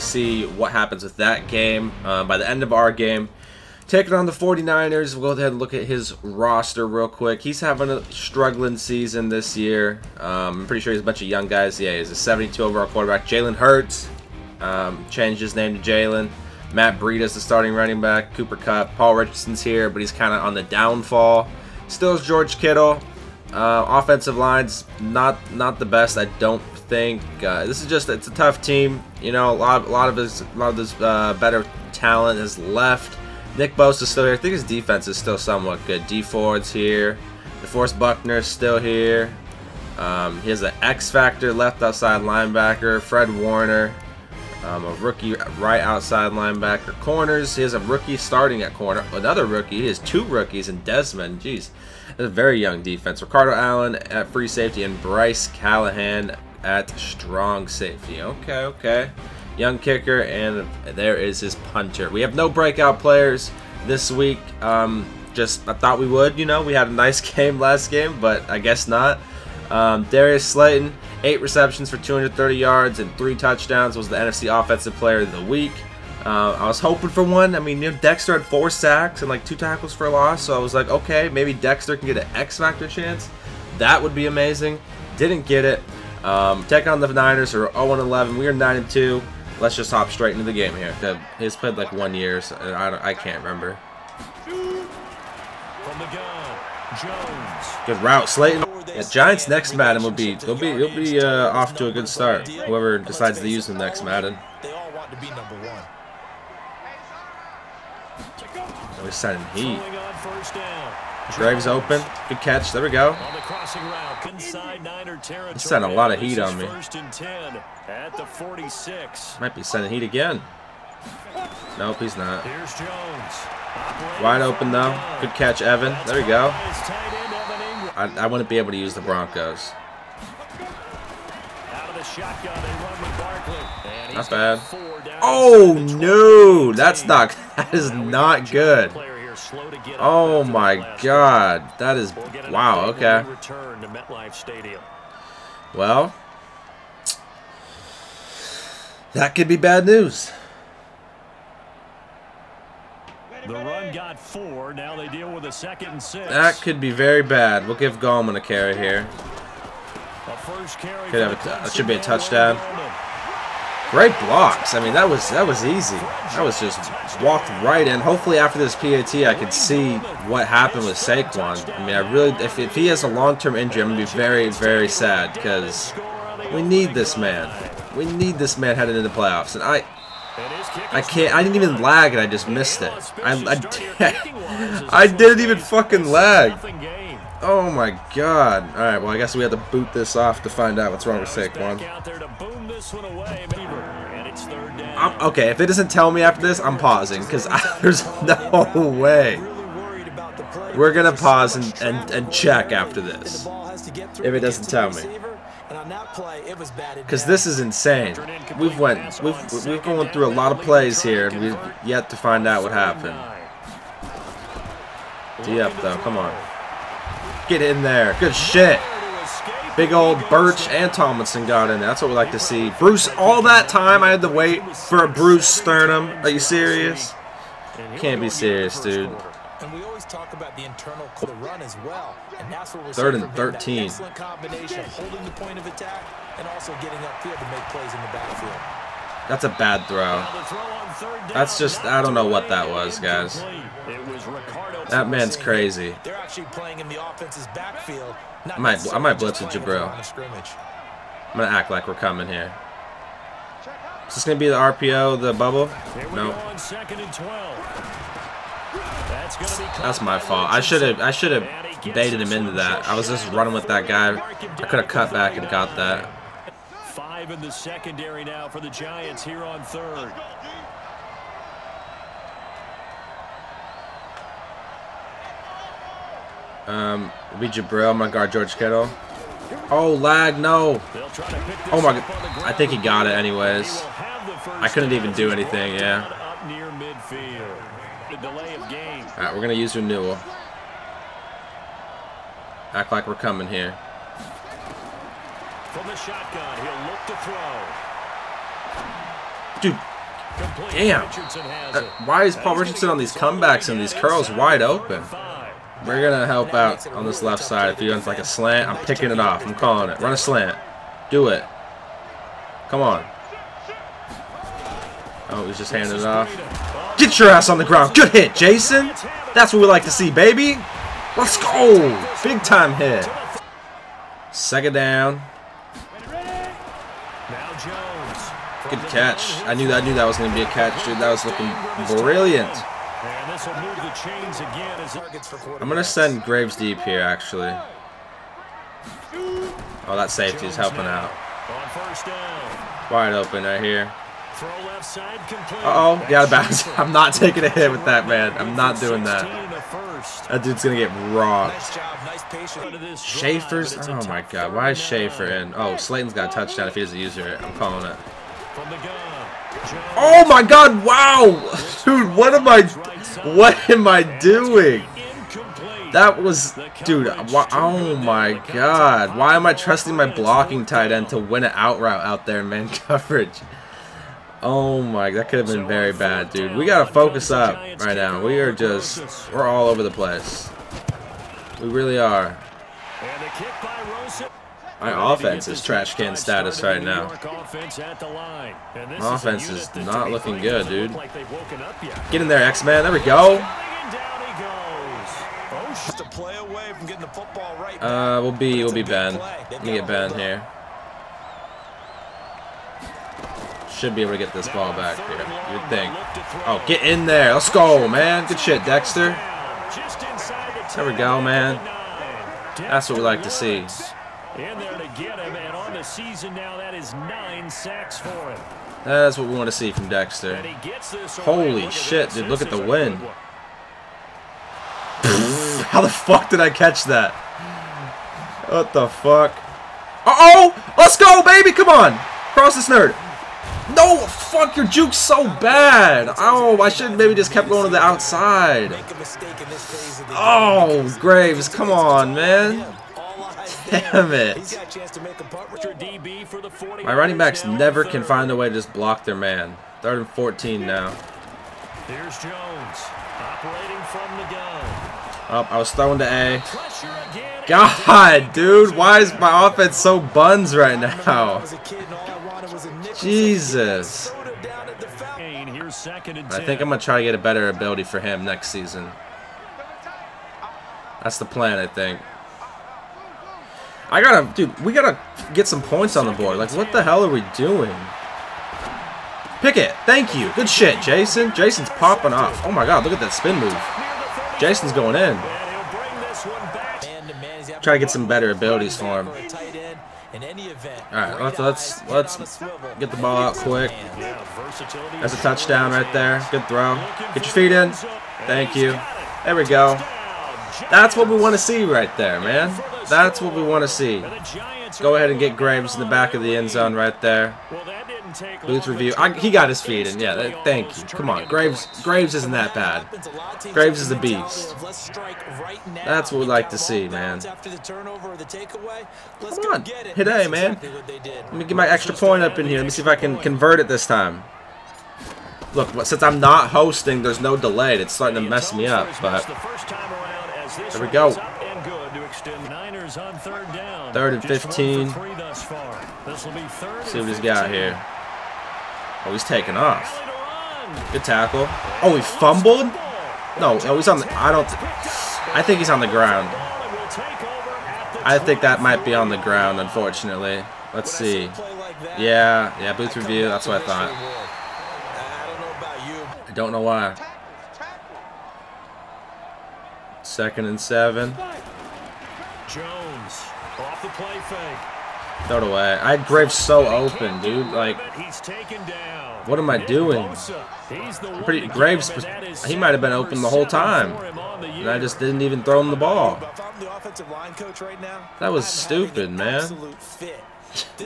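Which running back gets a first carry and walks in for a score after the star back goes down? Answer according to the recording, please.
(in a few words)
Gallman.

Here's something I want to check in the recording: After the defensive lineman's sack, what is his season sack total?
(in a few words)
9.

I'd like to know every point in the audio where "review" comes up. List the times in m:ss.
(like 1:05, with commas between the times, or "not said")
8:28, 9:12.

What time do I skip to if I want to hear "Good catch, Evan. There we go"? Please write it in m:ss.
2:05.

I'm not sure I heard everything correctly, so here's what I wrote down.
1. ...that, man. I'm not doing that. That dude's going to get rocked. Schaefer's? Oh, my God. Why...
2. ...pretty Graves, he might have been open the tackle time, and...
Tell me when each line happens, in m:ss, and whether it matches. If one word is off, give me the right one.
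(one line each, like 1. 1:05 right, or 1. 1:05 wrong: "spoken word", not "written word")
1. 5:47 right
2. 9:31 wrong: "whole", not "tackle".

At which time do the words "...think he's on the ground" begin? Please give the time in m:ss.
9:05.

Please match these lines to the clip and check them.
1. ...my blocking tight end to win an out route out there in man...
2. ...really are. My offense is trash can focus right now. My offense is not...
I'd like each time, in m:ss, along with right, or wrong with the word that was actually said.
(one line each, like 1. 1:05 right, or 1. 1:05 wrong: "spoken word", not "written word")
1. 6:09 right
2. 6:21 wrong: "status", not "focus".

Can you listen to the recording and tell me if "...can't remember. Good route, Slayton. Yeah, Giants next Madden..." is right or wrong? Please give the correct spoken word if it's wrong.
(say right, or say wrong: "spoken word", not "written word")
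right.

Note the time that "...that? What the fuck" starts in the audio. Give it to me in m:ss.
7:06.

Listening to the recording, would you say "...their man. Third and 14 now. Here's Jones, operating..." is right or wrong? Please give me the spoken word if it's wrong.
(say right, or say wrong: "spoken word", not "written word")
right.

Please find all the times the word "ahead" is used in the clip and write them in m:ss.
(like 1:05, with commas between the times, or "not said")
0:05, 8:24.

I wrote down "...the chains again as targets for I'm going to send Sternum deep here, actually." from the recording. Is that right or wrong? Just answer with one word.
wrong.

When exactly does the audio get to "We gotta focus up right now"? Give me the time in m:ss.
6:16.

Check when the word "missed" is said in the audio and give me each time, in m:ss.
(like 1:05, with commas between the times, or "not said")
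3:02.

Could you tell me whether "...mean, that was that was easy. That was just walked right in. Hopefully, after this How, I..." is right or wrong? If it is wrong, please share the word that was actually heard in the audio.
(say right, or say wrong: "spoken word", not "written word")
wrong: "PAT", not "How".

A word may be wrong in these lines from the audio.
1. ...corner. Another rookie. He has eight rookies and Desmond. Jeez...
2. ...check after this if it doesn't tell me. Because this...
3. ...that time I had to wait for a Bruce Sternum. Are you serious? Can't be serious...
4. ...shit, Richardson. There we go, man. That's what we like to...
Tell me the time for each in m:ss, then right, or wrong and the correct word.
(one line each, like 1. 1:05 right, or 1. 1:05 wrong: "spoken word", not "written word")
1. 0:48 wrong: "two", not "eight"
2. 3:22 right
3. 3:43 right
4. 6:48 wrong: "Dexter", not "Richardson".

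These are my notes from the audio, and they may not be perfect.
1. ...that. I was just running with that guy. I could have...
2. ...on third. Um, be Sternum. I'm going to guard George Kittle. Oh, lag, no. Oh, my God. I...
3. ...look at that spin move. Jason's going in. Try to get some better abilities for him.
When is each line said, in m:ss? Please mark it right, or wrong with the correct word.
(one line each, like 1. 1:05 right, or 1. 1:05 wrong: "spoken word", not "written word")
1. 4:22 right
2. 4:29 wrong: "Jabrill", not "Sternum"
3. 8:02 right.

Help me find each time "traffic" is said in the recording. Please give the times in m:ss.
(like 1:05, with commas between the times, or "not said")
not said.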